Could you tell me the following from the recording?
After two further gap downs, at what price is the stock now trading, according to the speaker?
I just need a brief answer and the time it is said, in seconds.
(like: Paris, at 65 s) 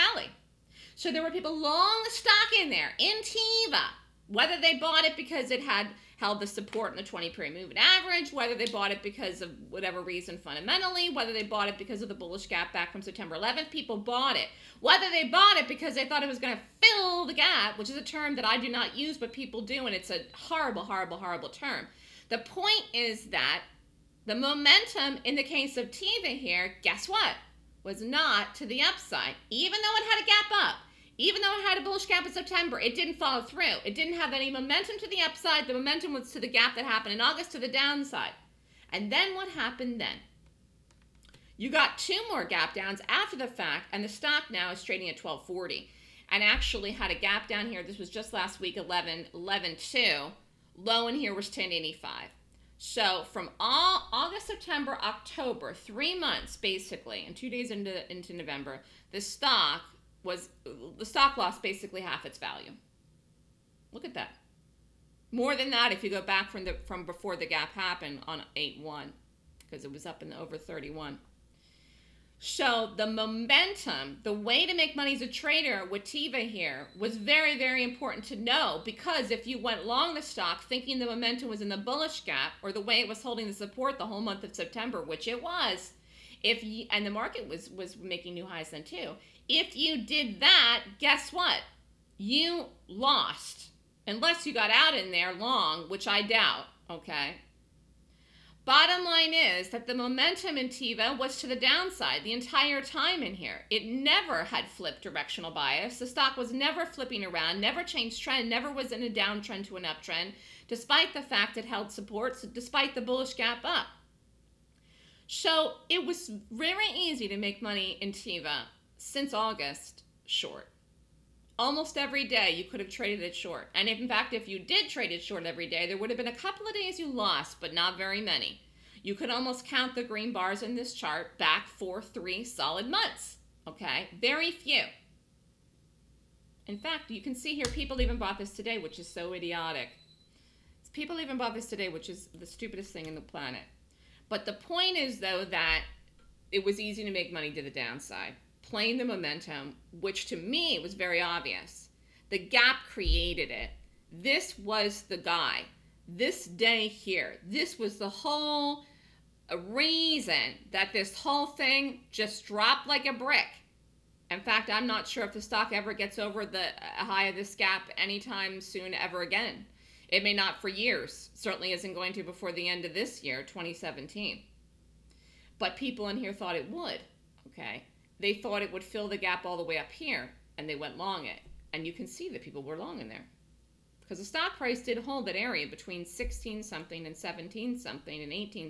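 12.40, at 45 s.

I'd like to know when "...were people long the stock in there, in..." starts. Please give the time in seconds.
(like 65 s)
1 s.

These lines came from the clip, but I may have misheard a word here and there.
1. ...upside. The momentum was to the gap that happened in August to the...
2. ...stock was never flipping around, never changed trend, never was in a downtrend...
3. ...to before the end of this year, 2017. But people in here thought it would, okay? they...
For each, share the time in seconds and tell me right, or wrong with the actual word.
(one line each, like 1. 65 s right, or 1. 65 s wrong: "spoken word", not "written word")
1. 35 s right
2. 106 s right
3. 172 s right.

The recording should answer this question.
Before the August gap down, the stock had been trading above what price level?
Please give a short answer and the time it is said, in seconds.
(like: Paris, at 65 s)
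31, at 70 s.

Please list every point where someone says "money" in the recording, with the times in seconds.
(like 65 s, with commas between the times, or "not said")
74 s, 117 s, 147 s.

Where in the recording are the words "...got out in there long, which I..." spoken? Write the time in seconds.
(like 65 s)
94 s.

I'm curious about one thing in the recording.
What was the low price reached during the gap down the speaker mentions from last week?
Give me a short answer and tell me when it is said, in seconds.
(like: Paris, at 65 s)
10.85, at 51 s.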